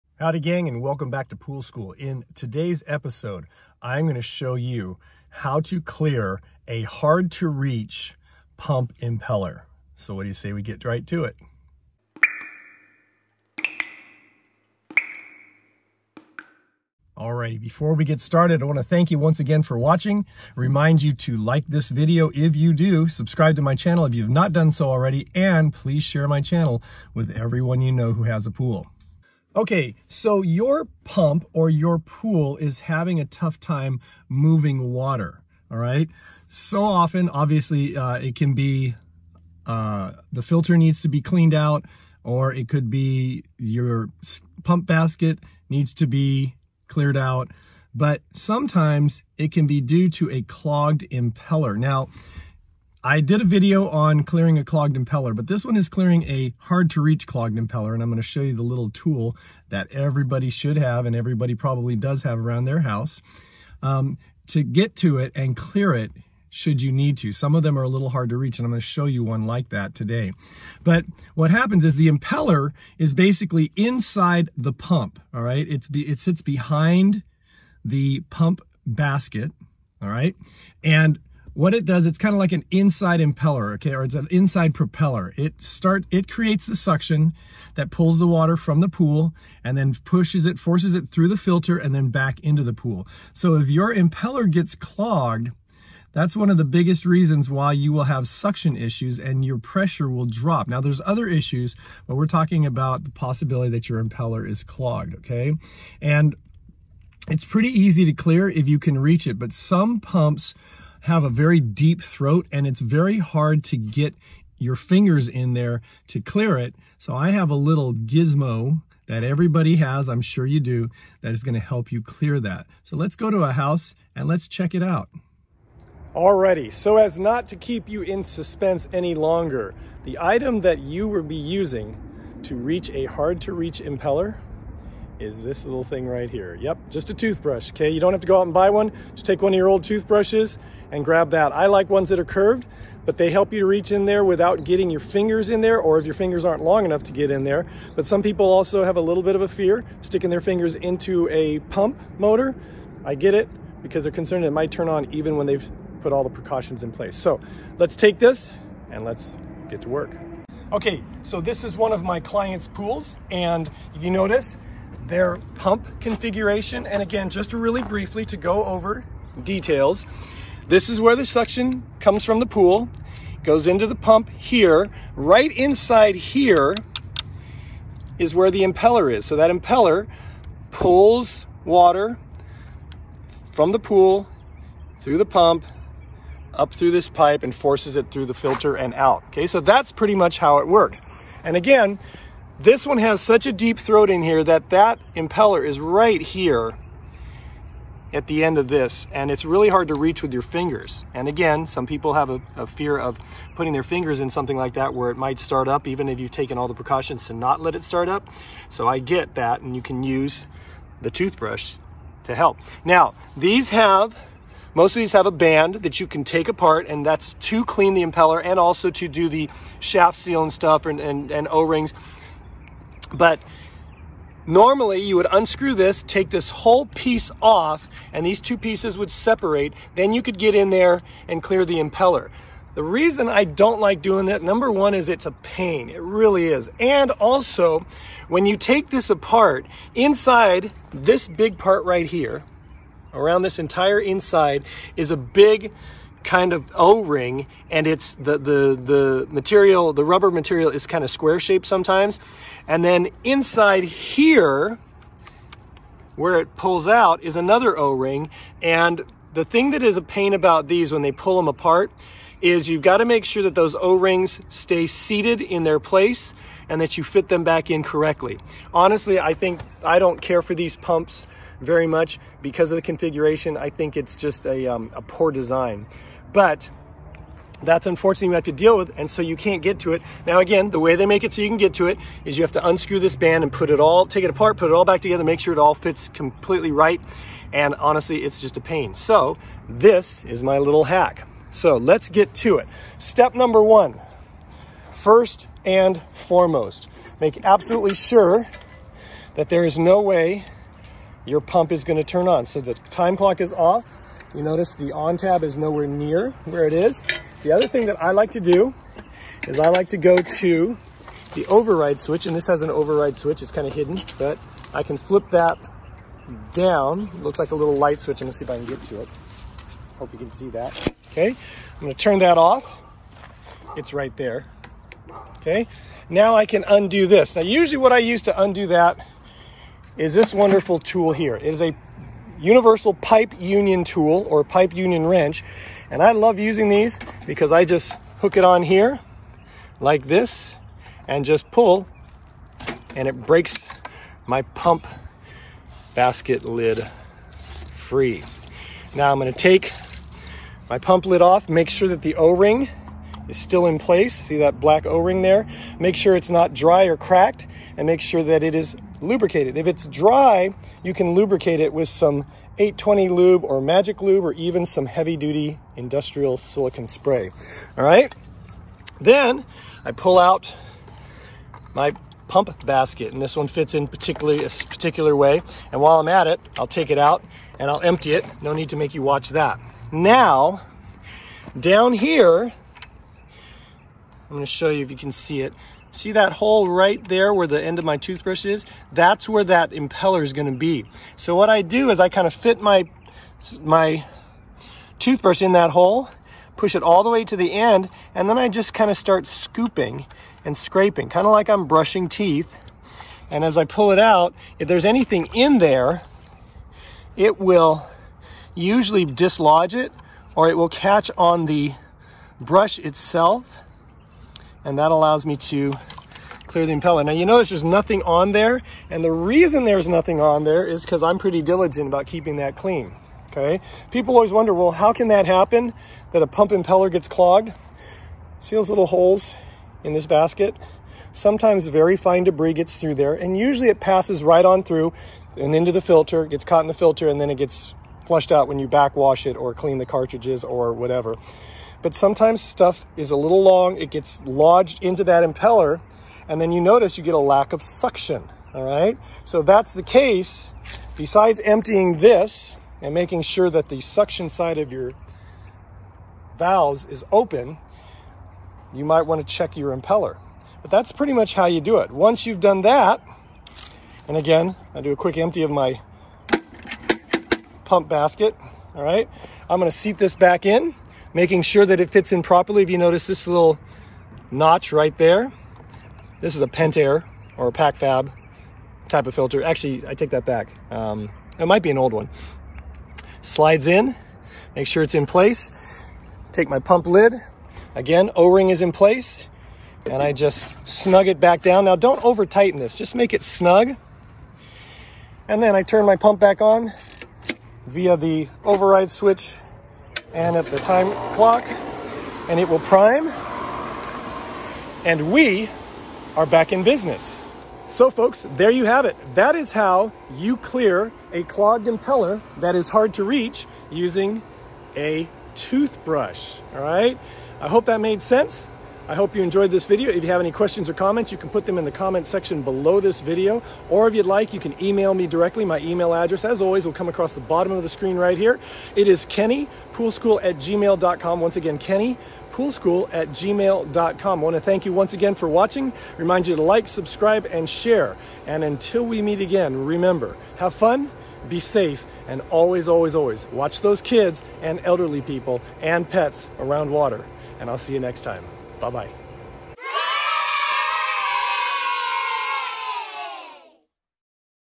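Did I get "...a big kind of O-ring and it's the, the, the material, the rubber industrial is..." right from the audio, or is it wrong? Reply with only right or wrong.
wrong.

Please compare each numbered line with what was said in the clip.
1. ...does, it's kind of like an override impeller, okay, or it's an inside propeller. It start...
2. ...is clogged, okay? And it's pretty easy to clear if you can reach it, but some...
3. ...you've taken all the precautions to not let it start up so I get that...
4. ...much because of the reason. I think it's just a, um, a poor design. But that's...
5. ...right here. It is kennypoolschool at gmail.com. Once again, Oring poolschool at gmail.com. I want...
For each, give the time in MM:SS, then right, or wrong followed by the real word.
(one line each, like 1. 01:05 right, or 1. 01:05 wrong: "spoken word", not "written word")
1. 01:21 wrong: "inside", not "override"
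2. 01:44 right
3. 03:26 right
4. 04:31 wrong: "configuration", not "reason"
5. 08:47 wrong: "Kenny", not "Oring".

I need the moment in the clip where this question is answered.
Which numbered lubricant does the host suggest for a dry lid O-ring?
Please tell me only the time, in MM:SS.
06:02.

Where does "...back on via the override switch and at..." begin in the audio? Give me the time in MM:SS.
08:16.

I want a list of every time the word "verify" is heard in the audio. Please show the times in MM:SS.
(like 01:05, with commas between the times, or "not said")
not said.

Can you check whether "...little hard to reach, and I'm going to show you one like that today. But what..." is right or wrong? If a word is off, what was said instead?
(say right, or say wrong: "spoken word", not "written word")
right.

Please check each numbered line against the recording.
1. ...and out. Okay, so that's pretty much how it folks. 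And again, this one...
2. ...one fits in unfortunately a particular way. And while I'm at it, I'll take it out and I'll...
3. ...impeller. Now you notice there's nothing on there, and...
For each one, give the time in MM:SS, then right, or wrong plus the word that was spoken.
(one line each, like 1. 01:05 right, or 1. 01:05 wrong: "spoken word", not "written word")
1. 03:08 wrong: "works", not "folks"
2. 06:13 wrong: "particularly", not "unfortunately"
3. 06:56 right.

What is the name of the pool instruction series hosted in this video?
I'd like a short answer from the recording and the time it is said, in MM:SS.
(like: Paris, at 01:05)
Pool School, at 00:01.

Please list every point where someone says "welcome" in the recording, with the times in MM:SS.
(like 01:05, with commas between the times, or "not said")
00:00.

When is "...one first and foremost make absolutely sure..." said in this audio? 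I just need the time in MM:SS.
04:53.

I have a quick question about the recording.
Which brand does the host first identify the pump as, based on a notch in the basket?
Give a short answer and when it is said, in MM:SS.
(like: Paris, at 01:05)
Pentair, at 07:56.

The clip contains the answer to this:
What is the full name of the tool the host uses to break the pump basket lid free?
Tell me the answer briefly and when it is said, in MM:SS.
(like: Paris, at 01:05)
Universal pipe union tool, at 05:32.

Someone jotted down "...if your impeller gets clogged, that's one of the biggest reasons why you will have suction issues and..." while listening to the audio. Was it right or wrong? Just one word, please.
right.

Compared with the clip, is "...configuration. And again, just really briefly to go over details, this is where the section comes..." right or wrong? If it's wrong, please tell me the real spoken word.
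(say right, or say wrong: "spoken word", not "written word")
wrong: "suction", not "section".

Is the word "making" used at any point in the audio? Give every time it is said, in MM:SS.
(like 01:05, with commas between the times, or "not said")
07:32, 07:51.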